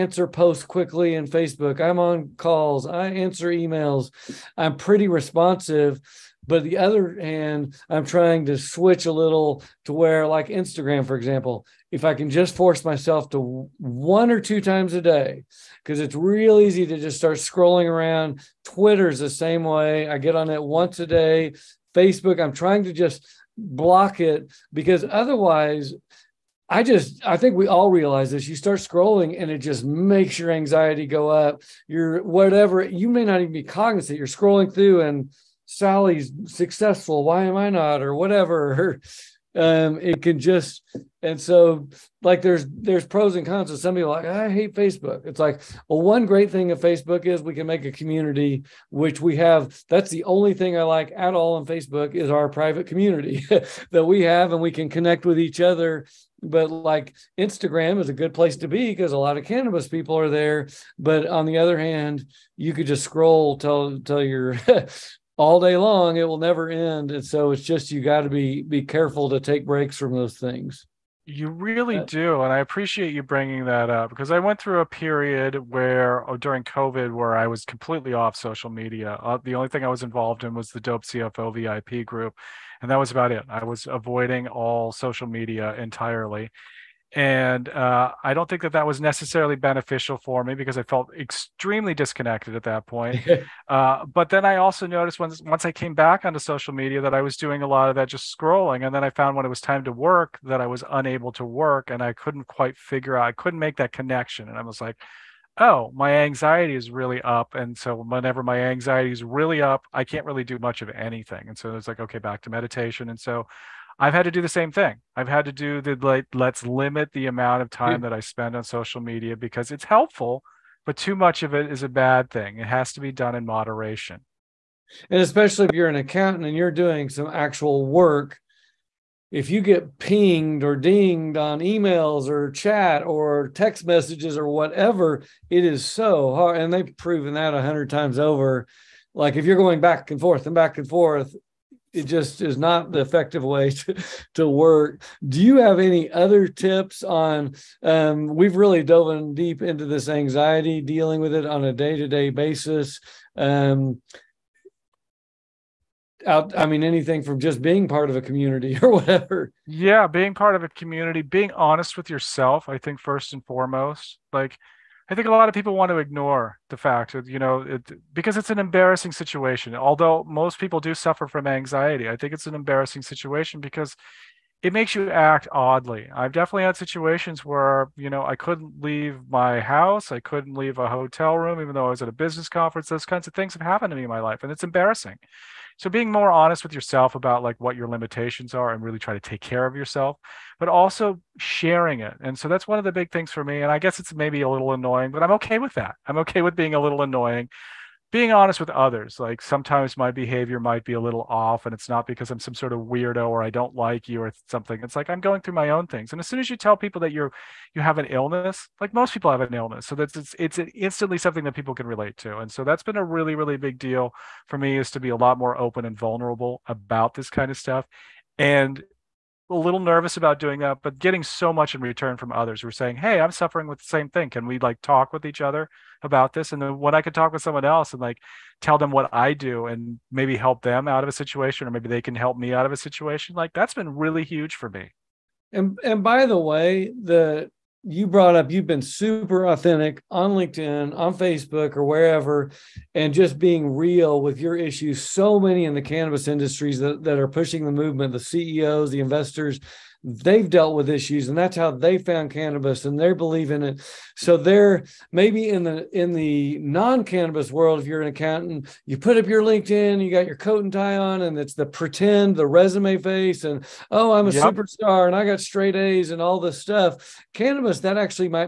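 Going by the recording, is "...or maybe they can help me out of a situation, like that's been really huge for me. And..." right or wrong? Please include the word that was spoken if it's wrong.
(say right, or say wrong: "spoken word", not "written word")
right.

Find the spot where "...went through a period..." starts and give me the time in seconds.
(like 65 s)
74 s.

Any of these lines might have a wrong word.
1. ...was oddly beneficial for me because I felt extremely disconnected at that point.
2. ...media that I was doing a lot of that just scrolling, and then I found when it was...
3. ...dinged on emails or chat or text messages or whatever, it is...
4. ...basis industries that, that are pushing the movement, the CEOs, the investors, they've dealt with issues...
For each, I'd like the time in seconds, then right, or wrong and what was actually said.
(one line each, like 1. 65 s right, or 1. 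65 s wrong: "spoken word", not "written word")
1. 88 s wrong: "necessarily", not "oddly"
2. 96 s right
3. 130 s right
4. 245 s wrong: "cannabis", not "basis".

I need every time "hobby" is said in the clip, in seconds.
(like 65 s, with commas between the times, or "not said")
not said.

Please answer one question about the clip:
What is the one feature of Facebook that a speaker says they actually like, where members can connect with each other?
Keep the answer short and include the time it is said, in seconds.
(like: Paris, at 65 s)
Private community, at 52 s.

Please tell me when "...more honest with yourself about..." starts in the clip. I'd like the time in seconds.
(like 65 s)
186 s.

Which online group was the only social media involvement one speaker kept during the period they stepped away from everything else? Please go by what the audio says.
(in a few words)
Dope CFO VIP group.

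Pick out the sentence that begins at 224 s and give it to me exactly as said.
Can we like talk with each other about this?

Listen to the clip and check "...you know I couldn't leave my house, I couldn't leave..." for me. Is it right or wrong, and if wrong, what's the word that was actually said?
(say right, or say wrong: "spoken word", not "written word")
right.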